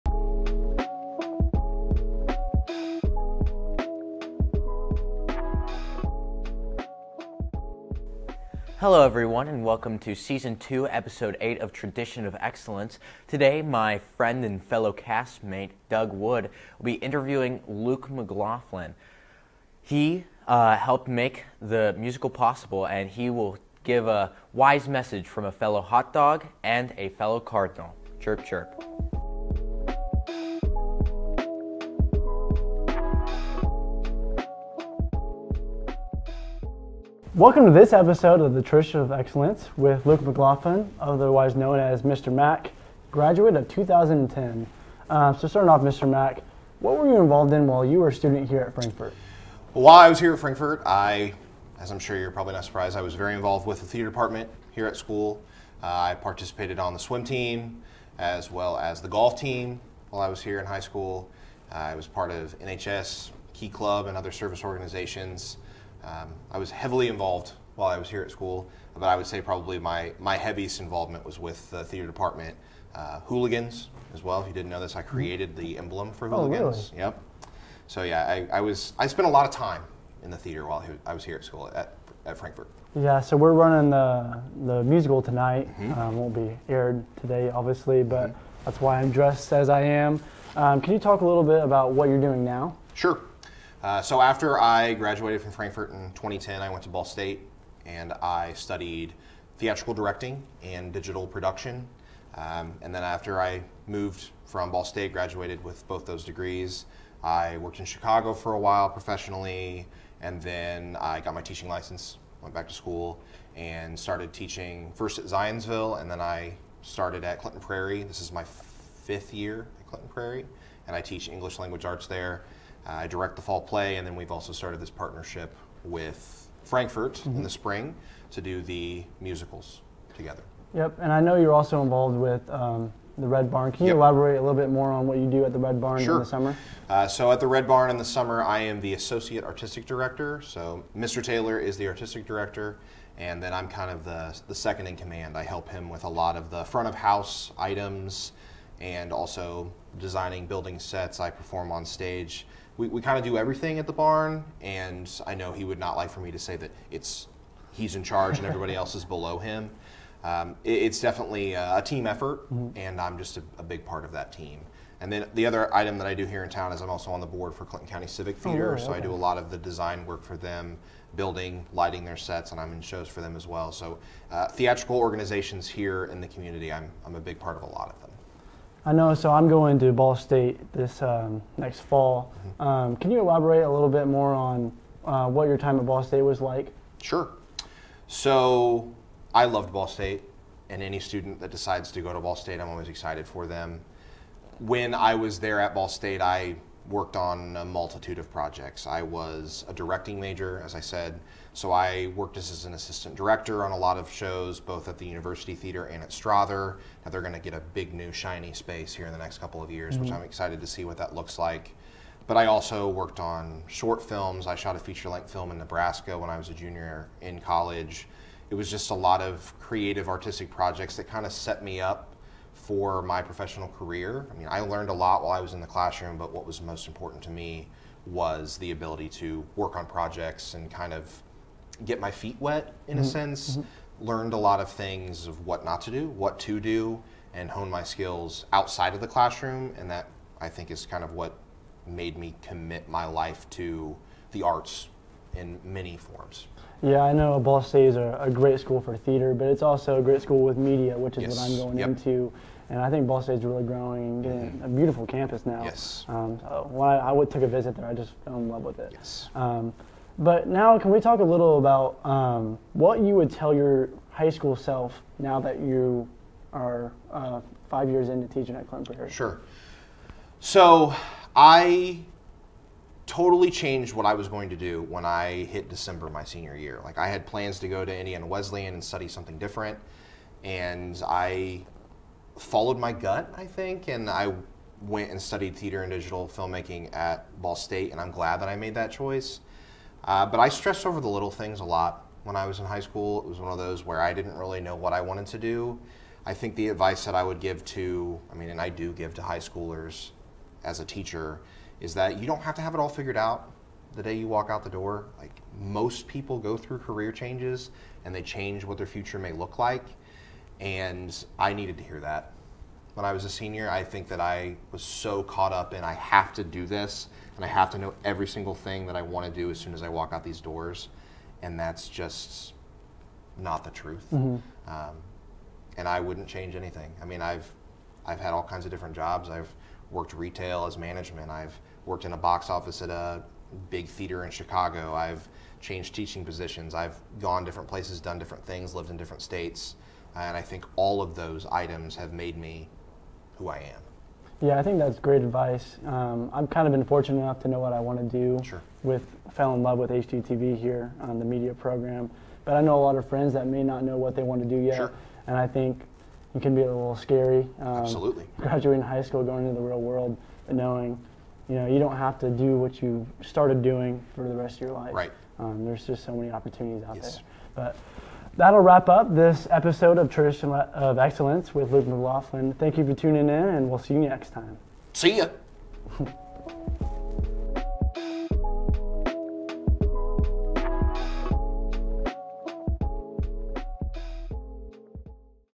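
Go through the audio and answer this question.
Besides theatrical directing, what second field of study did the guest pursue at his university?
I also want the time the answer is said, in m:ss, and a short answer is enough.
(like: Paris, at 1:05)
Digital production, at 1:40.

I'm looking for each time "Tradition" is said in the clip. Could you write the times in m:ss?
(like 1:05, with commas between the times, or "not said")
0:11, 6:10.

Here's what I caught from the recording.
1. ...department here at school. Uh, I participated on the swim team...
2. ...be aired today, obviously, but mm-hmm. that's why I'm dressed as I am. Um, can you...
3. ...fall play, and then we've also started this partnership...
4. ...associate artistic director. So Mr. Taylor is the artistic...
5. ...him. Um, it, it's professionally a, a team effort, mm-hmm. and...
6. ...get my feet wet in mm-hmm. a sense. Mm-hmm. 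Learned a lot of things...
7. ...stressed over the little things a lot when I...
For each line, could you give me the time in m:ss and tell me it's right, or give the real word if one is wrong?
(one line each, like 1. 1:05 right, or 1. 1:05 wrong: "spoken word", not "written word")
1. 0:54 right
2. 1:26 right
3. 2:03 right
4. 2:18 right
5. 2:39 wrong: "definitely", not "professionally"
6. 3:51 right
7. 4:50 right.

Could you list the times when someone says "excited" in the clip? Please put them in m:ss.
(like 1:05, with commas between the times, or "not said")
3:12, 3:30.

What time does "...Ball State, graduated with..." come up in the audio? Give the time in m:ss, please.
1:44.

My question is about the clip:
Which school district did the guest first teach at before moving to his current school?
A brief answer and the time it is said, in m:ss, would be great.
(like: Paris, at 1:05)
Zionsville, at 1:55.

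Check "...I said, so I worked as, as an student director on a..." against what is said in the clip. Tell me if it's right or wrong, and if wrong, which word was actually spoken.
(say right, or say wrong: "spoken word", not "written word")
wrong: "assistant", not "student".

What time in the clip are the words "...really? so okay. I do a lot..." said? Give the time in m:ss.
2:48.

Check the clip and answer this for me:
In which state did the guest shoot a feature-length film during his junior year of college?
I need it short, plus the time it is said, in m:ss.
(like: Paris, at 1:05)
Nebraska, at 3:35.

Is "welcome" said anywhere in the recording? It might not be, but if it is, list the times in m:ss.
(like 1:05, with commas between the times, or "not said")
0:09, 0:37.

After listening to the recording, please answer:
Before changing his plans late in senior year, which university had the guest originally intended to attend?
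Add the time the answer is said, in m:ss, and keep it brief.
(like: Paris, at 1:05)
Indiana Wesleyan, at 4:37.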